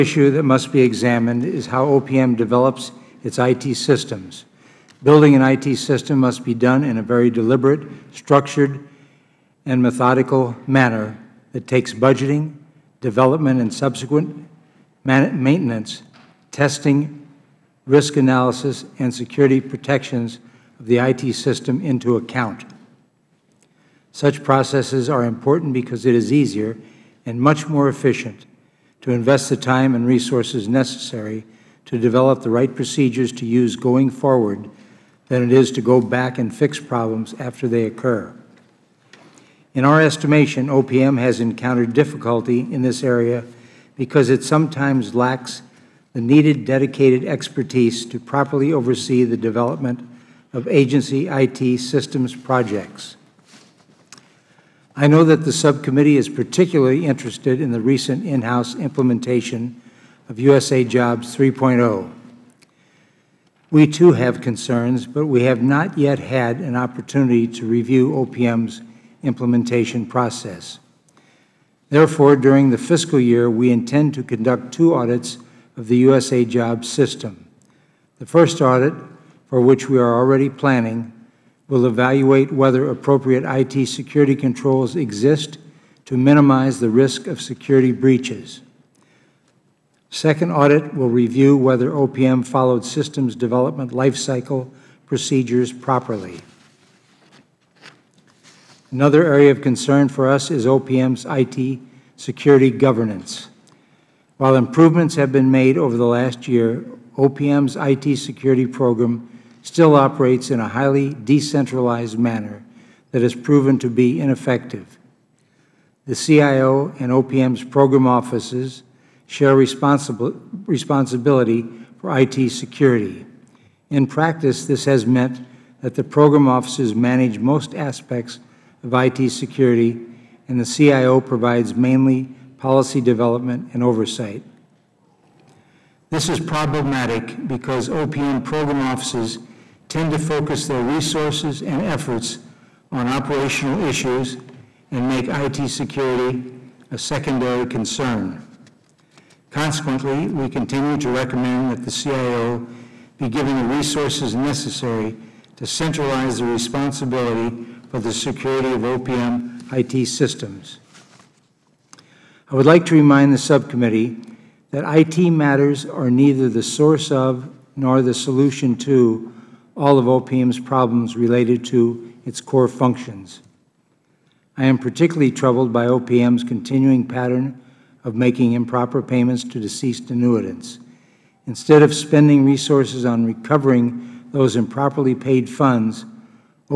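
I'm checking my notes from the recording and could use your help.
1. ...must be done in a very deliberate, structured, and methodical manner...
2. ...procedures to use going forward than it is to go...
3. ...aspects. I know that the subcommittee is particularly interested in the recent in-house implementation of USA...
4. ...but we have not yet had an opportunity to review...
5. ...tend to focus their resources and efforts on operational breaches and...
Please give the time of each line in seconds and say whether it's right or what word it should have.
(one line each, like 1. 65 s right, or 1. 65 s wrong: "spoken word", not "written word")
1. 6 s right
2. 32 s right
3. 52 s wrong: "projects", not "aspects"
4. 65 s right
5. 139 s wrong: "issues", not "breaches".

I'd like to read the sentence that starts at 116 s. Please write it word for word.
The CIO and OPM's program offices share responsibility for IT security.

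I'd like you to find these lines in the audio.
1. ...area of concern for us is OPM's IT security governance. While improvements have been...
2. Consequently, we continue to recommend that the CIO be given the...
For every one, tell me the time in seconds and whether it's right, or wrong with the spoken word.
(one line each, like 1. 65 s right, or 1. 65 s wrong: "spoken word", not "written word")
1. 99 s right
2. 149 s right.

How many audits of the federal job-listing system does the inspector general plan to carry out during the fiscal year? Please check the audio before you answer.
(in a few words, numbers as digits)
2.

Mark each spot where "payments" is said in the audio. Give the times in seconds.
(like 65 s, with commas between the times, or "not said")
179 s.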